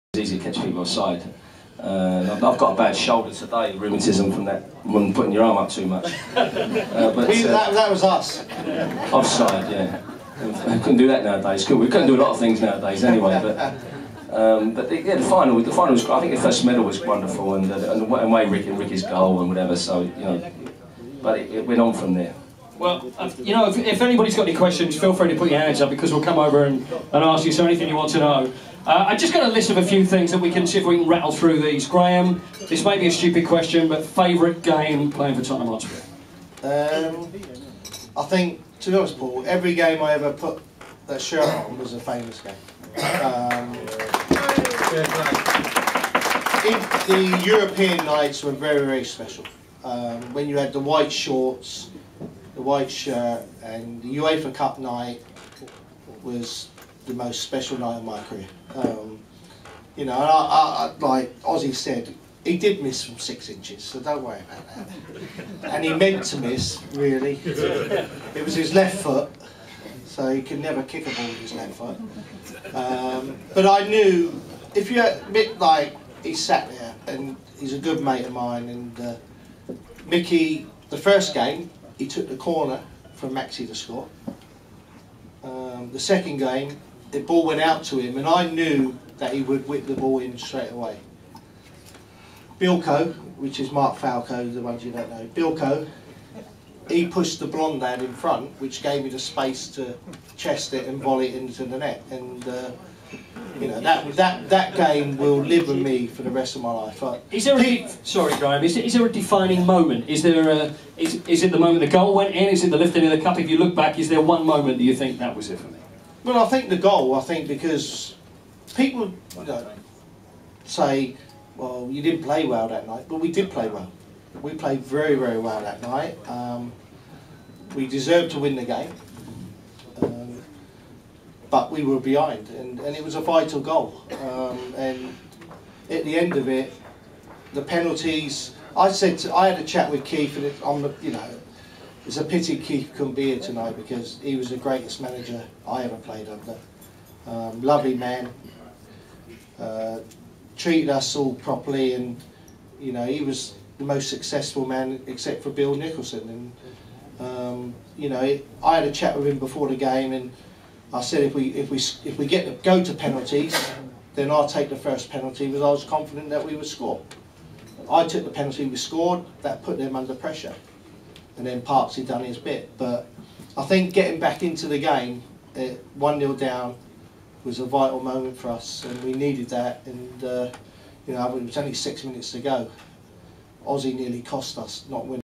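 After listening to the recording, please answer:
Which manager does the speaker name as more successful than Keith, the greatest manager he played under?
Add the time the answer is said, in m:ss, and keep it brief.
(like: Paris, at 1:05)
Bill Nicholson, at 2:35.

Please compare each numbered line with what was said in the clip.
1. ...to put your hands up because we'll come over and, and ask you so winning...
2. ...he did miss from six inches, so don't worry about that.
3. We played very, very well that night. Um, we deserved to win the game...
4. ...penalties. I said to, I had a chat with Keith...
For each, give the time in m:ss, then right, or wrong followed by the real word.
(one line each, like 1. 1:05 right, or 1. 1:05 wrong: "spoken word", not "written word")
1. 0:25 wrong: "anything", not "winning"
2. 1:02 right
3. 2:04 right
4. 2:17 right.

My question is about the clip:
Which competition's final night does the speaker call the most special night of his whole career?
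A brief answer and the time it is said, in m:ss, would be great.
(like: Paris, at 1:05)
UEFA Cup, at 0:54.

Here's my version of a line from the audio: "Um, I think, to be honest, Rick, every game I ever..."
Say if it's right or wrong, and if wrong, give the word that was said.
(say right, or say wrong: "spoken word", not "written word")
wrong: "Paul", not "Rick".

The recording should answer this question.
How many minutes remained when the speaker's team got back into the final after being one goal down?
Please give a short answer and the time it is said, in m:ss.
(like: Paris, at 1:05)
6, at 3:01.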